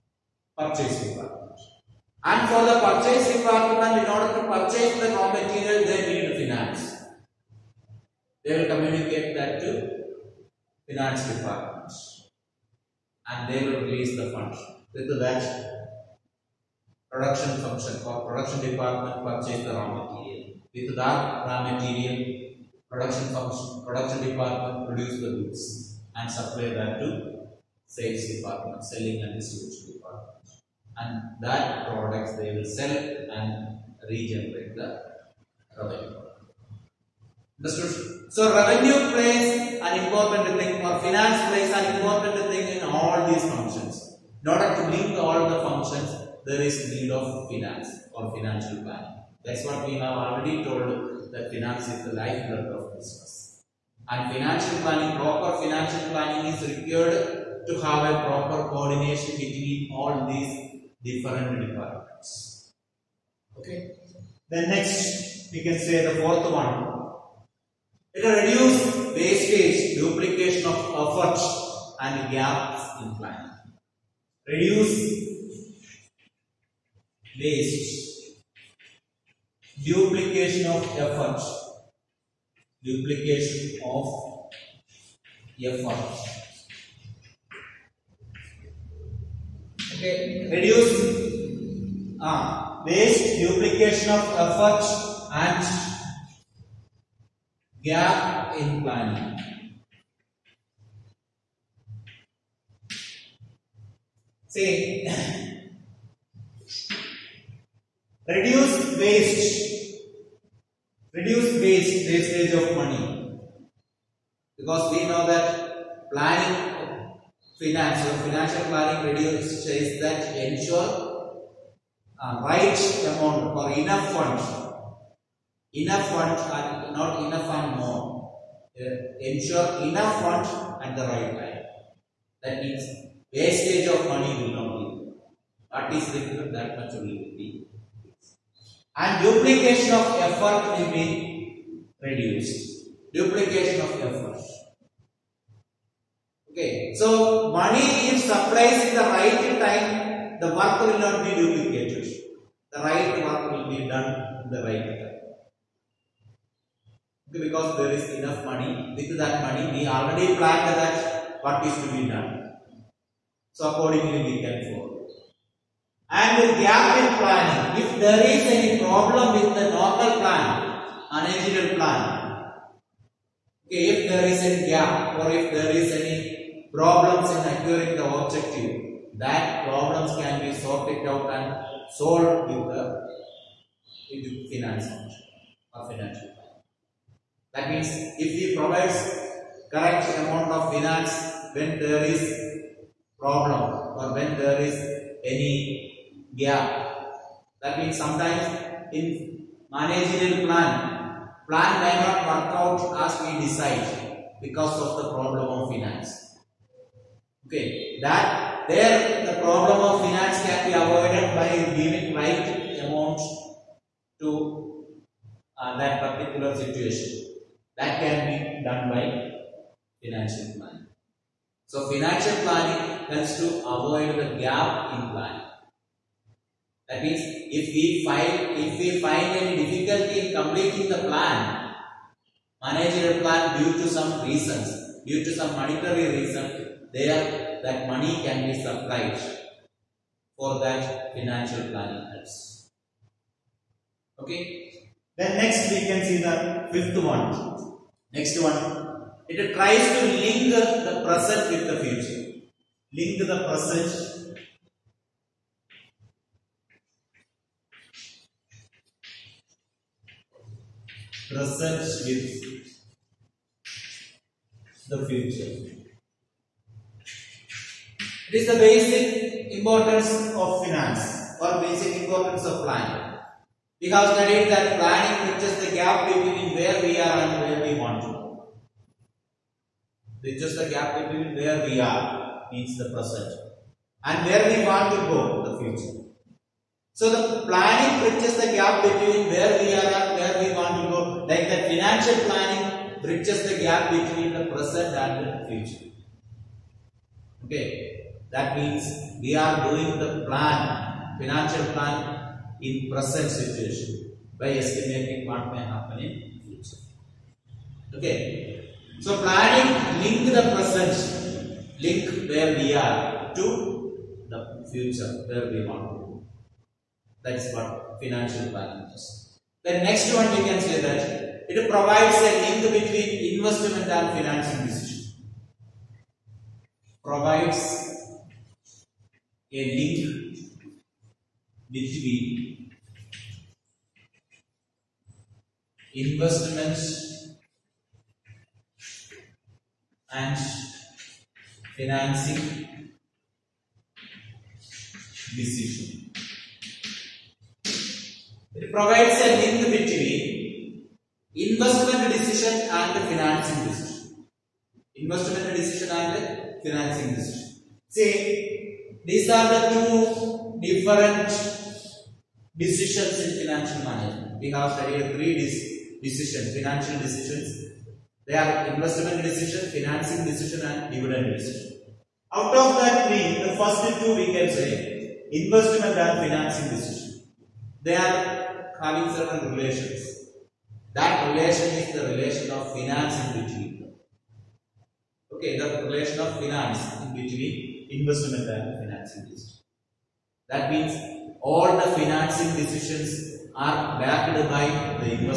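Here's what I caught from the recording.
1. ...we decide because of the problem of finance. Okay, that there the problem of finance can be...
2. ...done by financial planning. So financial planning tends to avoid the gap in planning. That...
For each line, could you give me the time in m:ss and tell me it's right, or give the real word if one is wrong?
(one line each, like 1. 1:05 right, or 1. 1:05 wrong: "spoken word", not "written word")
1. 3:23 right
2. 3:38 right.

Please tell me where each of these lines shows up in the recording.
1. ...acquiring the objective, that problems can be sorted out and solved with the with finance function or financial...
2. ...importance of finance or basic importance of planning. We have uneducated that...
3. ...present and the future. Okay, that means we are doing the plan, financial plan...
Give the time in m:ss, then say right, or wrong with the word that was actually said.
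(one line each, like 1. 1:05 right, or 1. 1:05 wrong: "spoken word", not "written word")
1. 2:57 right
2. 4:29 wrong: "studied", not "uneducated"
3. 4:54 right.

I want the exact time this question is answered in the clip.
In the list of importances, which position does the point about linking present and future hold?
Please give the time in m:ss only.
4:06.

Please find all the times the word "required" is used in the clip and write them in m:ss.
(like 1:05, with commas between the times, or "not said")
0:56.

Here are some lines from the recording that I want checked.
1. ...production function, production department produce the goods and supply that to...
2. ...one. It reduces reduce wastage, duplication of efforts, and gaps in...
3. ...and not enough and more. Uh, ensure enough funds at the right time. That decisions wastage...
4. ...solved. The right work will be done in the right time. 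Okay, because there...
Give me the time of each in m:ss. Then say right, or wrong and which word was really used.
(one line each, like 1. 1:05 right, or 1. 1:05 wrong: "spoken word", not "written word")
1. 0:22 right
2. 1:06 right
3. 2:06 wrong: "means", not "decisions"
4. 2:31 wrong: "duplicated", not "solved".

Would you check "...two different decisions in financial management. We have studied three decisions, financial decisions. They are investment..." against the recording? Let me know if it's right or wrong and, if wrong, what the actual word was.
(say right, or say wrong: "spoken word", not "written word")
right.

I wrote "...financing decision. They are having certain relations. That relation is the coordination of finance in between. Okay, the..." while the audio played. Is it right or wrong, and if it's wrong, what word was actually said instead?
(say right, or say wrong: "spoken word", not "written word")
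wrong: "relation", not "coordination".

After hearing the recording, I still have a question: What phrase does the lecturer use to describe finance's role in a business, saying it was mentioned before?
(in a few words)
Lifeblood of business.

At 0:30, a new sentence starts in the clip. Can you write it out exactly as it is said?
And that products they will sell and regenerate the revenue.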